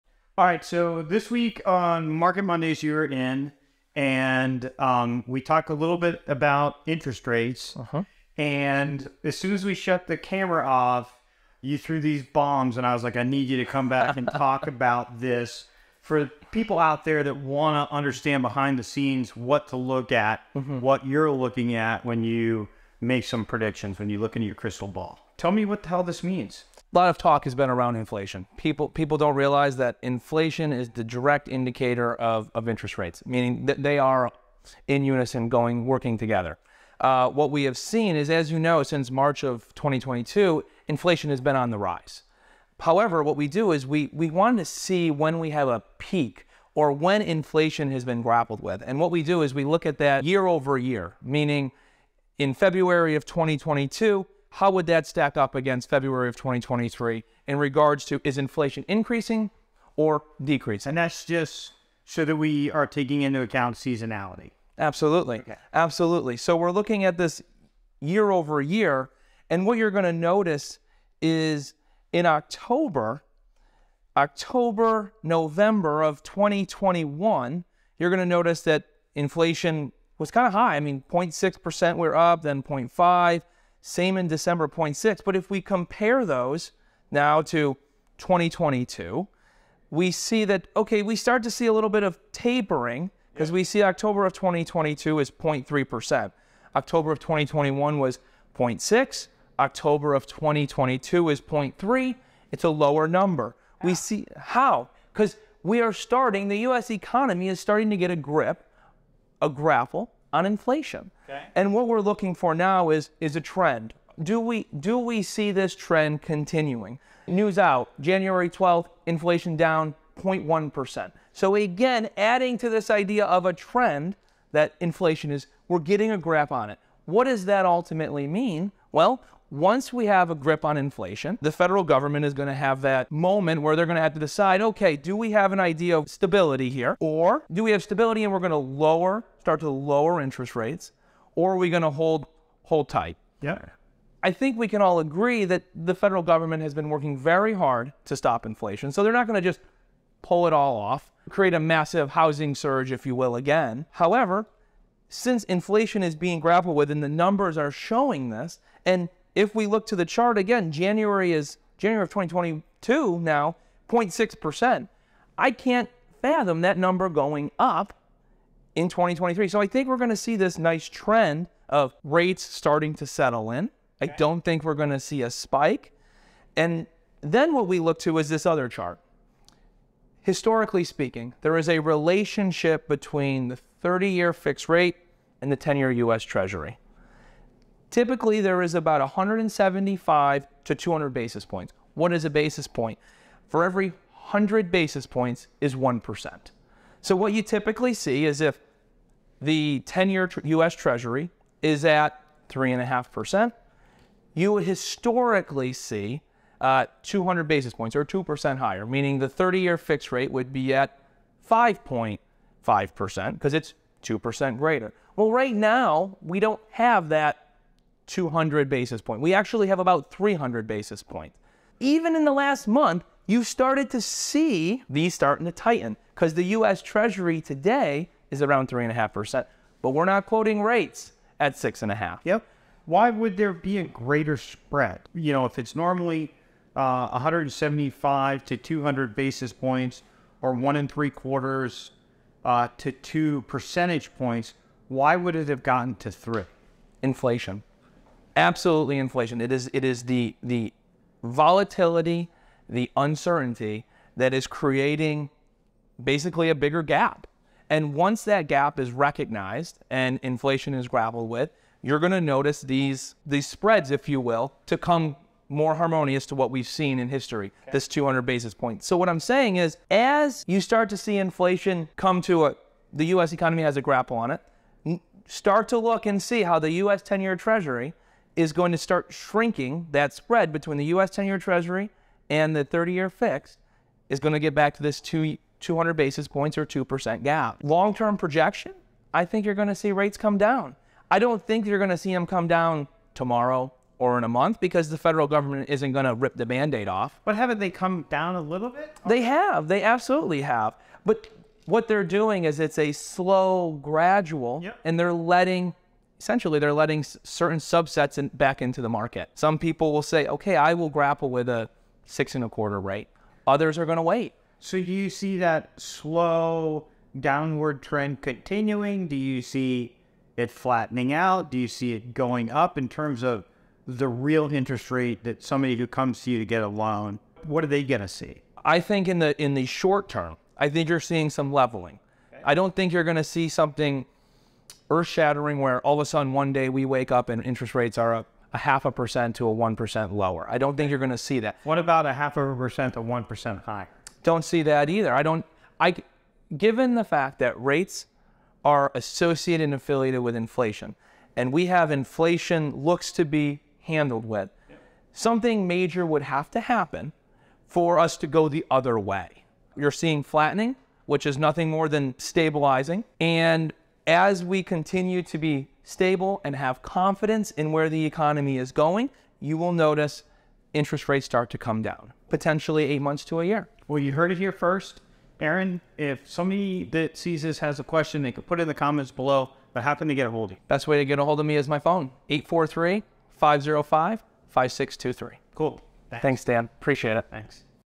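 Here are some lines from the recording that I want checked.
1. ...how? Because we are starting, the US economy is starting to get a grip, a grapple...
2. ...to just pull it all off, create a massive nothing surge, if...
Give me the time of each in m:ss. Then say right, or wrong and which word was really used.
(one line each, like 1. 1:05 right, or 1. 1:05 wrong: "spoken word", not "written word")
1. 1:44 right
2. 2:29 wrong: "housing", not "nothing".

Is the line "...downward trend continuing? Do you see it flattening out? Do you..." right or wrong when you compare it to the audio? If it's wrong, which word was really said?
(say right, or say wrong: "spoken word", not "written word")
right.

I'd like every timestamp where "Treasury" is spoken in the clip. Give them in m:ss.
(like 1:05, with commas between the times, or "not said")
3:06, 3:20, 3:46, 4:37, 4:41.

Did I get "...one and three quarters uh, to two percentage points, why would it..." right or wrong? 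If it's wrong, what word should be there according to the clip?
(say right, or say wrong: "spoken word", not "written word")
right.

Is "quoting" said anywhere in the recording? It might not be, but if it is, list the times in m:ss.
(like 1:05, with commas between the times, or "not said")
3:50.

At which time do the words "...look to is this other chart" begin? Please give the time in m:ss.
2:57.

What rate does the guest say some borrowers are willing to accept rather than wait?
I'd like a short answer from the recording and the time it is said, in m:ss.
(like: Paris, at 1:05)
6.25%, at 5:12.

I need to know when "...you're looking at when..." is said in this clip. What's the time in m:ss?
0:21.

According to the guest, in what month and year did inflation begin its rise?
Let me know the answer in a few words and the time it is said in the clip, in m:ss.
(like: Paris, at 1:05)
March 2022, at 0:39.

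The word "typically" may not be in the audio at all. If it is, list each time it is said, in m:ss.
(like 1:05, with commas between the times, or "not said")
3:07, 3:17.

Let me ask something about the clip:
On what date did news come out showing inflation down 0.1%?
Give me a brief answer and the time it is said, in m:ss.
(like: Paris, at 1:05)
January 12th, at 1:57.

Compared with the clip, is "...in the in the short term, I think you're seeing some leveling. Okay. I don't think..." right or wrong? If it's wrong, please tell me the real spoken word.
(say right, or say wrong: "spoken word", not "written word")
right.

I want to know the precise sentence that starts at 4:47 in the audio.
Long-term projection, I think you're going to see rates come down.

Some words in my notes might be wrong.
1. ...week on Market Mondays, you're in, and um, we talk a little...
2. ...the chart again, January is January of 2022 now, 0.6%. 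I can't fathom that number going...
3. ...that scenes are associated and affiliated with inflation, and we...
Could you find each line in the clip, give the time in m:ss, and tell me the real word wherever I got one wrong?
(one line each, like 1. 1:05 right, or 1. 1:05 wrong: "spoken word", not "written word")
1. 0:01 right
2. 2:39 right
3. 5:47 wrong: "rates", not "scenes".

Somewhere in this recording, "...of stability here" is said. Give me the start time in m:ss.
2:15.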